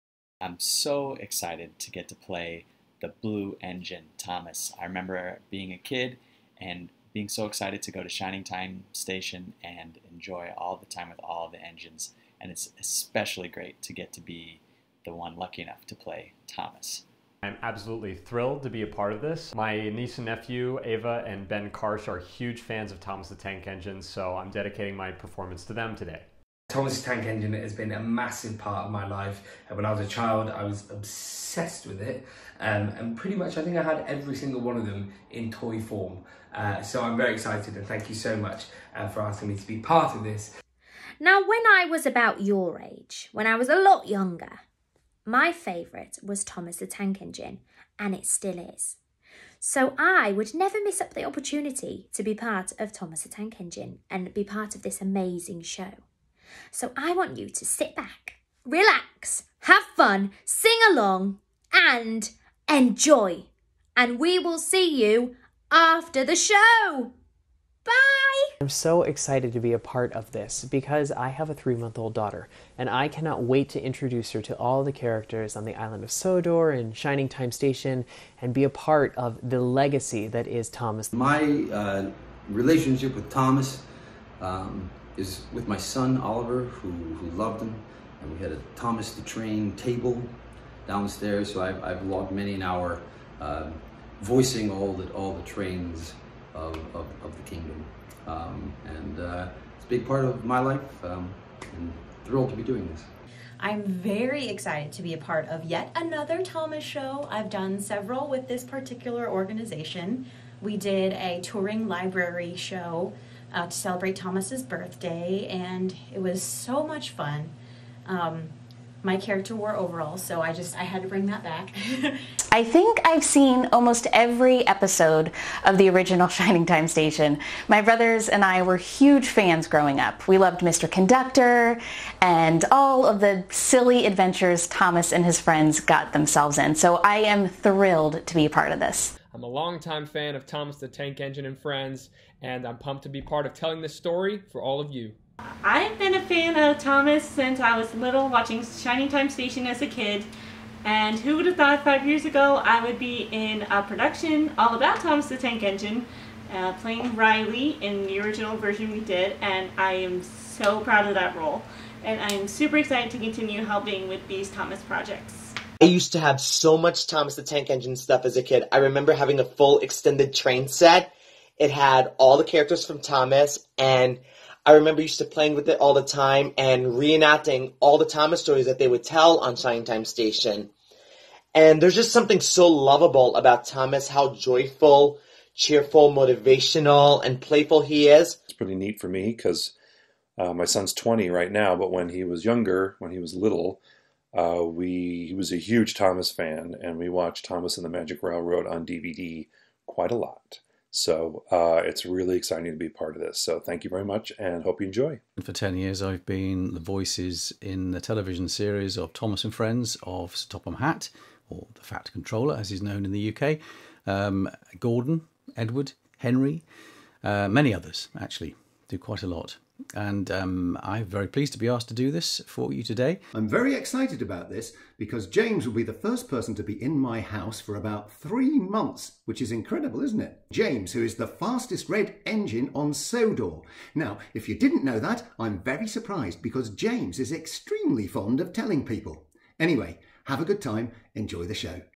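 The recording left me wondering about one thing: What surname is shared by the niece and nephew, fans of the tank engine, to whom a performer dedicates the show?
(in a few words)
Karsh.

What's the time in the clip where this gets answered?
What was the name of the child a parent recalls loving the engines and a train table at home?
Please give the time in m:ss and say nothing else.
1:26.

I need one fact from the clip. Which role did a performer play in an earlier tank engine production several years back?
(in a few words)
Riley.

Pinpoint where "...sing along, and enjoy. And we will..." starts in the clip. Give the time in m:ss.
1:00.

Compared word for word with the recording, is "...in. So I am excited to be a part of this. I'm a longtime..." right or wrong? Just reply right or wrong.
wrong.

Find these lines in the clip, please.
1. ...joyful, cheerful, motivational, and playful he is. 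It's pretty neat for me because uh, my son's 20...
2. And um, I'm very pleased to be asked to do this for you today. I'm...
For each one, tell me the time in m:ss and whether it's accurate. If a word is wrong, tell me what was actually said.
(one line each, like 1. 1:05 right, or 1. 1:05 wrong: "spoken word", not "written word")
1. 3:04 right
2. 3:39 right.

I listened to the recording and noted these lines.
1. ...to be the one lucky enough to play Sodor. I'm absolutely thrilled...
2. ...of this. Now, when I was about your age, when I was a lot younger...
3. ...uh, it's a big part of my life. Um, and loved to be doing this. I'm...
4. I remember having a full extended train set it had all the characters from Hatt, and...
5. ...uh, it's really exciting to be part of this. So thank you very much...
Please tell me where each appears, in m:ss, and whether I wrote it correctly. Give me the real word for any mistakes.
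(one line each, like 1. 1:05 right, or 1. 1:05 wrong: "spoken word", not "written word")
1. 0:14 wrong: "Thomas", not "Sodor"
2. 0:40 right
3. 1:39 wrong: "thrilled", not "loved"
4. 2:48 wrong: "Thomas", not "Hatt"
5. 3:21 right.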